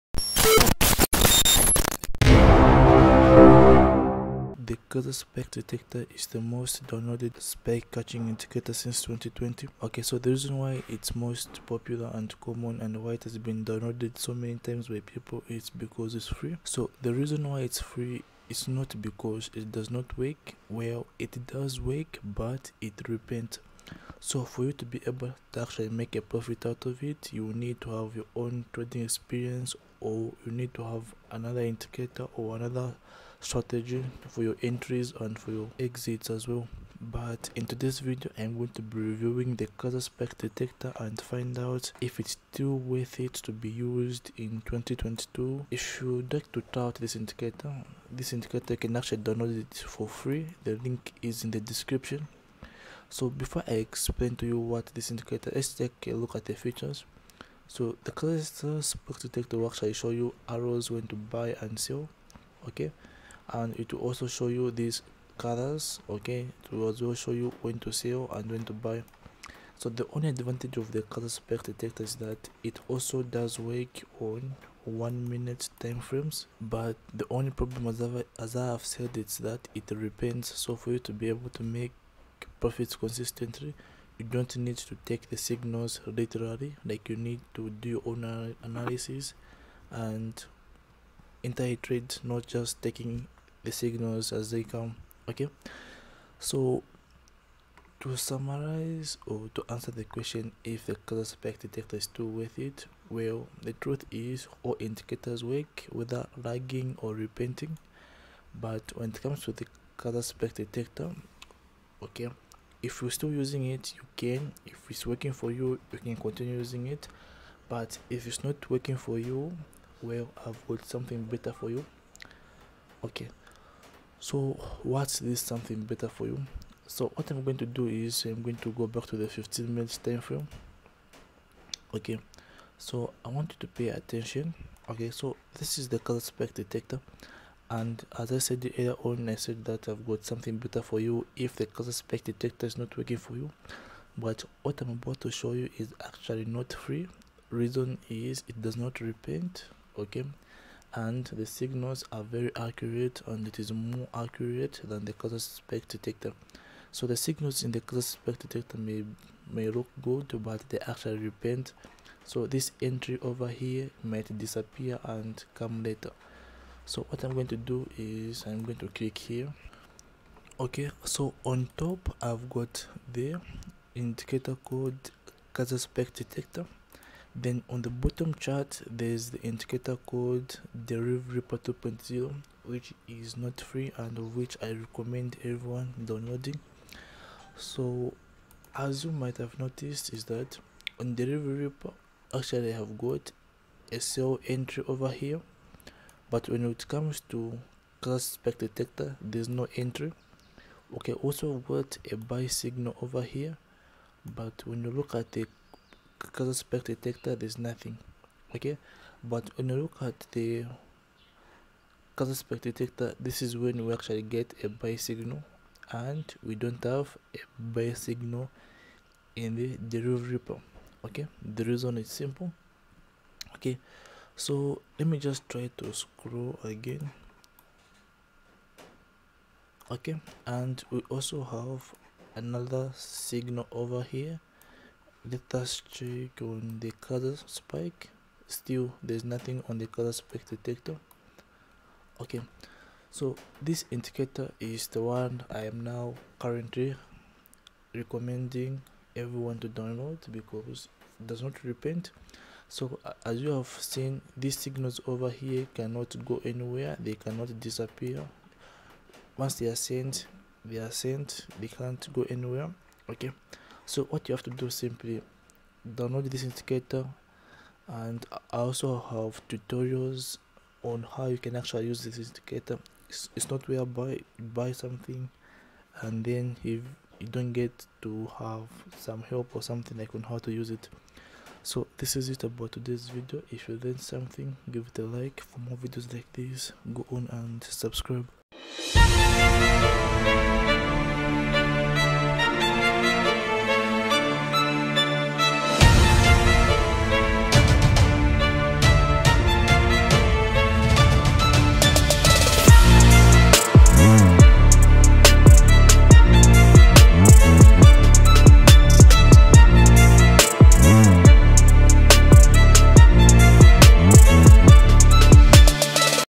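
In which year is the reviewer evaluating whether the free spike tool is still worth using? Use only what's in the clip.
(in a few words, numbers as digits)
2022.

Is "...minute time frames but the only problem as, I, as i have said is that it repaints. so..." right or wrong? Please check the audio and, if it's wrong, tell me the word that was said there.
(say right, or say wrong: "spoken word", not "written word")
right.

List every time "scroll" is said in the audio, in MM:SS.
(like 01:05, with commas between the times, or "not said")
03:45.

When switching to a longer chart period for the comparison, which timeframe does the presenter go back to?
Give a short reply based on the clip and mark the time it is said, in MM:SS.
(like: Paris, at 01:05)
15 minutes, at 02:09.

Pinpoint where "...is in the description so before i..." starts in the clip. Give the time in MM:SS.
00:51.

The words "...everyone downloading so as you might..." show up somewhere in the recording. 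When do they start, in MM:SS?
03:05.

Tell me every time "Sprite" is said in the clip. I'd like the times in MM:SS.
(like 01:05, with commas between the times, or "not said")
not said.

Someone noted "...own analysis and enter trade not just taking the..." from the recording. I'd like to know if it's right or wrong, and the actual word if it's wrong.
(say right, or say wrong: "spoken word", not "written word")
right.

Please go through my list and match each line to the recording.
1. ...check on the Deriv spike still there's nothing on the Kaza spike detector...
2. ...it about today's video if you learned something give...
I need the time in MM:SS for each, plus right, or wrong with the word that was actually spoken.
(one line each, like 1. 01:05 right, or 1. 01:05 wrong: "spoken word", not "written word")
1. 03:55 wrong: "Kaza", not "Deriv"
2. 04:42 right.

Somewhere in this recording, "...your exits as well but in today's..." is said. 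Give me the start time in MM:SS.
00:35.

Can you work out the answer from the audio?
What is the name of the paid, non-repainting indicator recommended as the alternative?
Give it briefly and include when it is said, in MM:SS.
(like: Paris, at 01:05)
Deriv Ripper 2.0, at 03:00.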